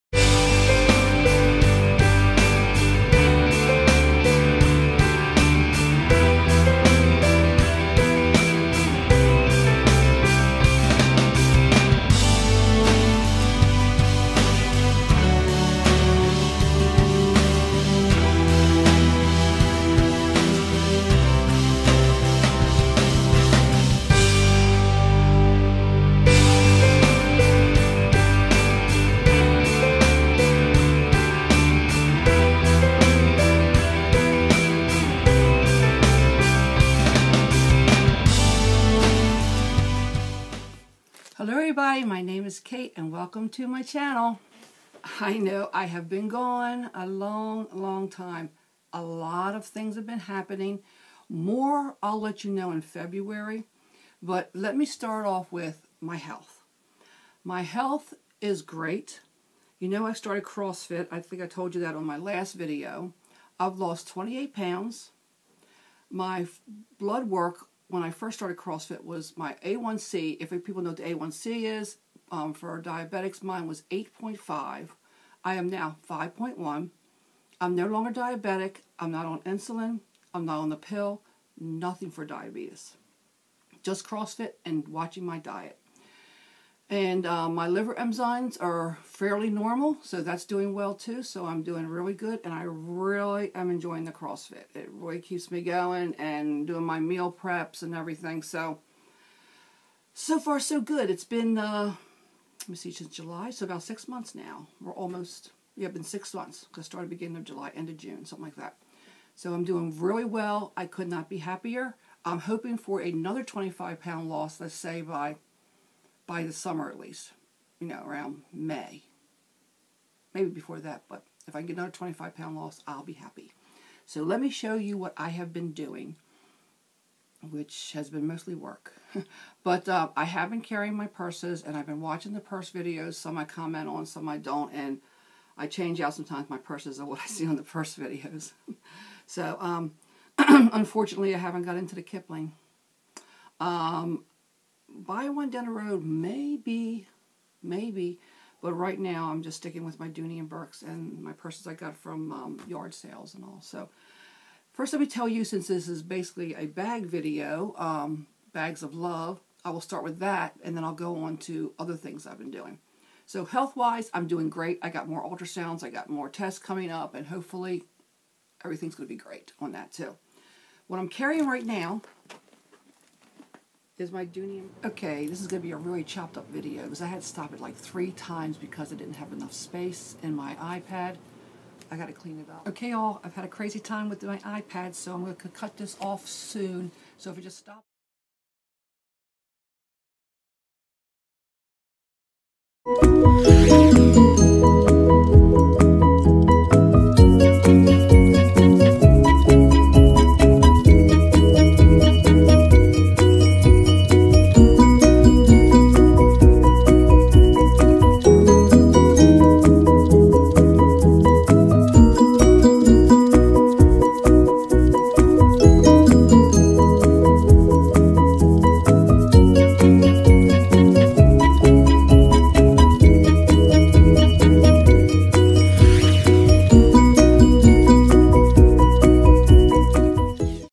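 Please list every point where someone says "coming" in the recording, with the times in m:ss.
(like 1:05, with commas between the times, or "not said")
2:46.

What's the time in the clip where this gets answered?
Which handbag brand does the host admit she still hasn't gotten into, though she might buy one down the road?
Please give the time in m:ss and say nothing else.
2:22.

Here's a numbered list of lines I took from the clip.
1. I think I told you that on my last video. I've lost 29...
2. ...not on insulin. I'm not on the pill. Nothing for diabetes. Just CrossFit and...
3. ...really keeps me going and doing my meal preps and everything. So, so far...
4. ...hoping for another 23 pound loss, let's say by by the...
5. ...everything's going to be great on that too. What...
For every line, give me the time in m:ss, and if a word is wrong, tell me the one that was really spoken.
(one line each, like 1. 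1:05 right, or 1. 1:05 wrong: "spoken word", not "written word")
1. 1:01 wrong: "28", not "29"
2. 1:19 right
3. 1:34 right
4. 1:52 wrong: "25", not "23"
5. 2:48 right.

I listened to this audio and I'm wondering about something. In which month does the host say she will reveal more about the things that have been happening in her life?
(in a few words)
February.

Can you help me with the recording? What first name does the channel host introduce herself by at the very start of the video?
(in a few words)
Kate.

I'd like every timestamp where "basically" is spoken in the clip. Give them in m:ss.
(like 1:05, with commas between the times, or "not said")
2:36.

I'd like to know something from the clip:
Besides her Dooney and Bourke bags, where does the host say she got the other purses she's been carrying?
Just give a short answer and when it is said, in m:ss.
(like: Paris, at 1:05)
yard sales, at 2:32.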